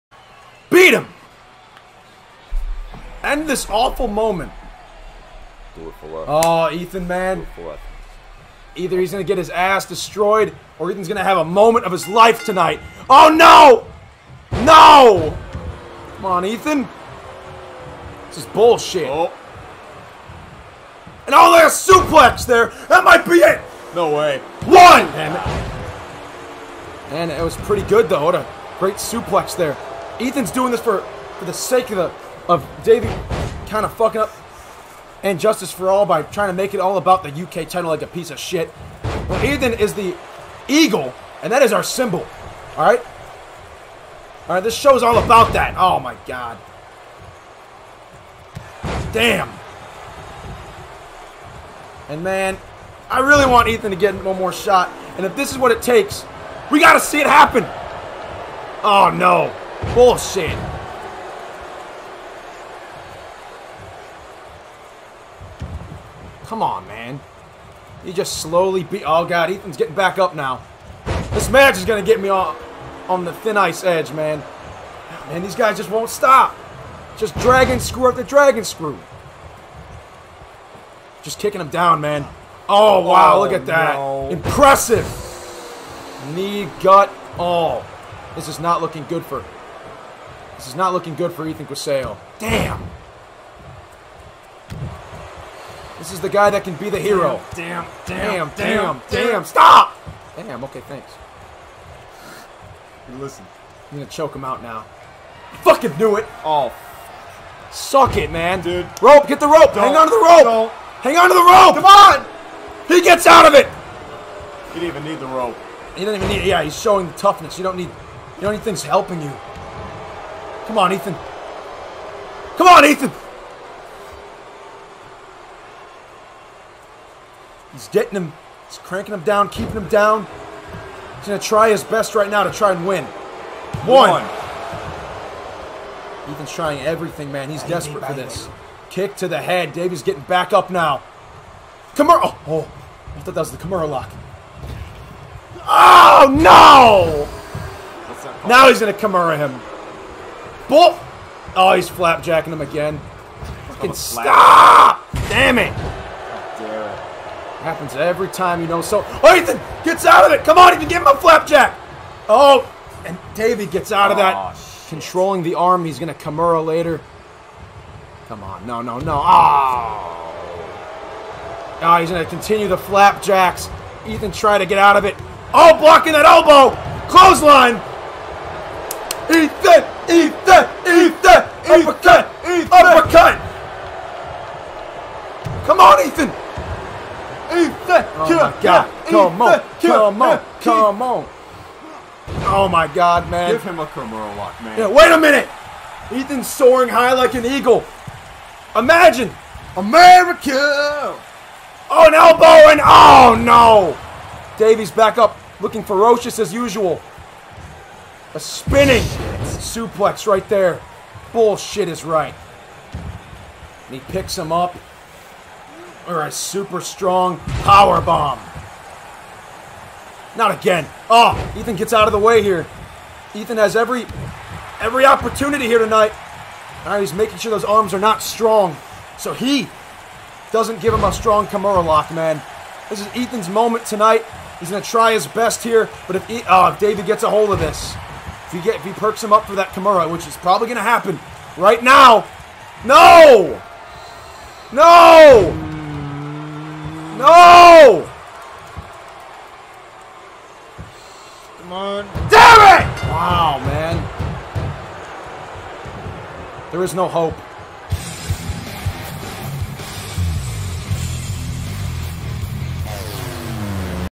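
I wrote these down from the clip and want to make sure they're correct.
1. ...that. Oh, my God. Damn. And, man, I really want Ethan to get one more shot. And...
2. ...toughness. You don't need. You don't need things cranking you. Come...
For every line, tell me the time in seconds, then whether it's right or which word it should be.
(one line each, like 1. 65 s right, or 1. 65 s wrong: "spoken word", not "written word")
1. 45 s right
2. 117 s wrong: "helping", not "cranking".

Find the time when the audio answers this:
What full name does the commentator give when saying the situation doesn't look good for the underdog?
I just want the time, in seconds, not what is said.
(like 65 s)
91 s.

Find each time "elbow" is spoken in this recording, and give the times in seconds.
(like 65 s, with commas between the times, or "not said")
176 s, 202 s.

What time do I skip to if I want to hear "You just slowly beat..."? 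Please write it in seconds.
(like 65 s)
68 s.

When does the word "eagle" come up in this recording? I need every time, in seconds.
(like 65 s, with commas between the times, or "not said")
40 s, 197 s.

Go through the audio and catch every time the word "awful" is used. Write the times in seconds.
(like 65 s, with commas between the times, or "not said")
3 s.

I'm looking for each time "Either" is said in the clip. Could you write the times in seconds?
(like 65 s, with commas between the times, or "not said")
8 s.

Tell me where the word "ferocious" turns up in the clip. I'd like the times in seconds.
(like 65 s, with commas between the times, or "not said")
205 s.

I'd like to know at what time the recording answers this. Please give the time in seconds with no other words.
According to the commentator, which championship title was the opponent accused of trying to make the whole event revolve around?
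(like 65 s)
37 s.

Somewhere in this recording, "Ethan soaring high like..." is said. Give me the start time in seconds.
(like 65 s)
196 s.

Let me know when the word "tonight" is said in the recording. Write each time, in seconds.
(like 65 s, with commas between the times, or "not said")
12 s, 225 s, 233 s.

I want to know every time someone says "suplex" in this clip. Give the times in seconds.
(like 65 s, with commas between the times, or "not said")
21 s, 28 s, 209 s.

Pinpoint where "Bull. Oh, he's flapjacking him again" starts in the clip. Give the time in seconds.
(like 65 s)
150 s.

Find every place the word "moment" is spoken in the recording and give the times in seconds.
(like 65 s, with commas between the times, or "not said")
4 s, 11 s, 233 s.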